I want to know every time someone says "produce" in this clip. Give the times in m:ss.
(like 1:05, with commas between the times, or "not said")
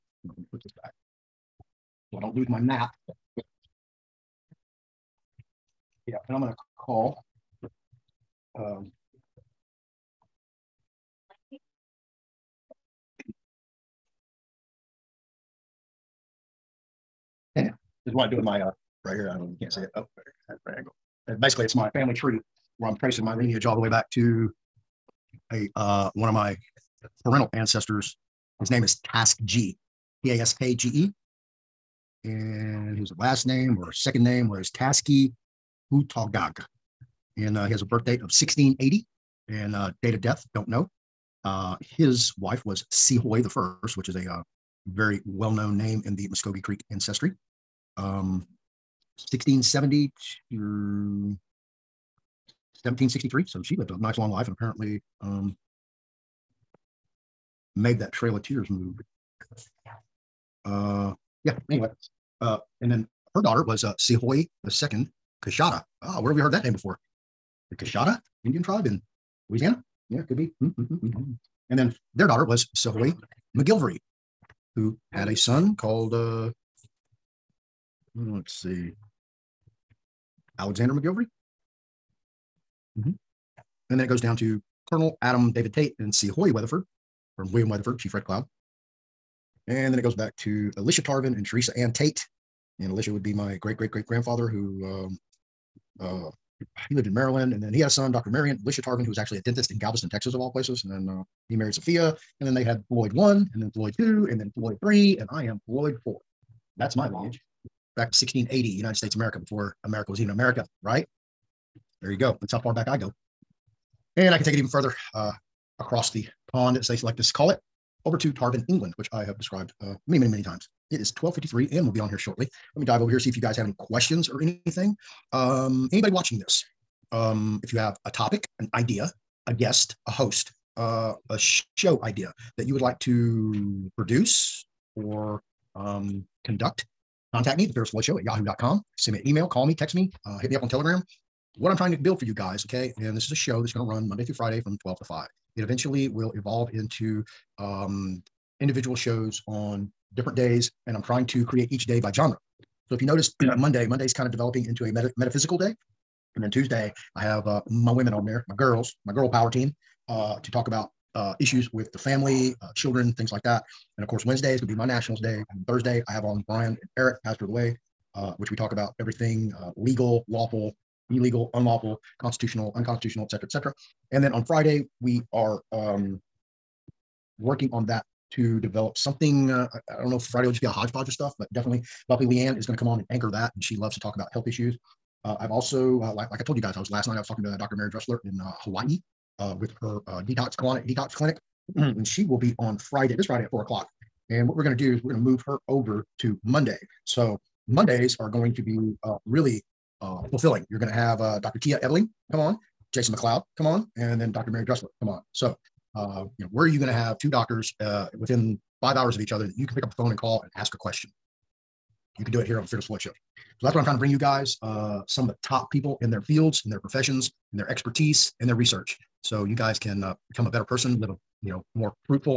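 2:13.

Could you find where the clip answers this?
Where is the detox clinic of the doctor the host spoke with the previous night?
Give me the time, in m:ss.
3:08.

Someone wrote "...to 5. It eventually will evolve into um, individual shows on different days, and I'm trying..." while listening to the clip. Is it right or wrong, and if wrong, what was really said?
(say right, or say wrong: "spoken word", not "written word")
right.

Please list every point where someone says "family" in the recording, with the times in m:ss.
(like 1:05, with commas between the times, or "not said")
0:21, 2:41.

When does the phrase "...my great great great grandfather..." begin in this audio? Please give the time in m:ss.
1:33.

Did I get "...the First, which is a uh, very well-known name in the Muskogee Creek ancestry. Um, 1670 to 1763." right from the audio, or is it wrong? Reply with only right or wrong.
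right.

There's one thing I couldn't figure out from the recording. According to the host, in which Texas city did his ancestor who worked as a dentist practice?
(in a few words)
Galveston.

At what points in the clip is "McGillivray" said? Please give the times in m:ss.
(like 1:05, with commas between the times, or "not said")
1:13, 1:20.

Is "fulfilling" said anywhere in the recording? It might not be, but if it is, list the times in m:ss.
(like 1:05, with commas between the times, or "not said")
3:20.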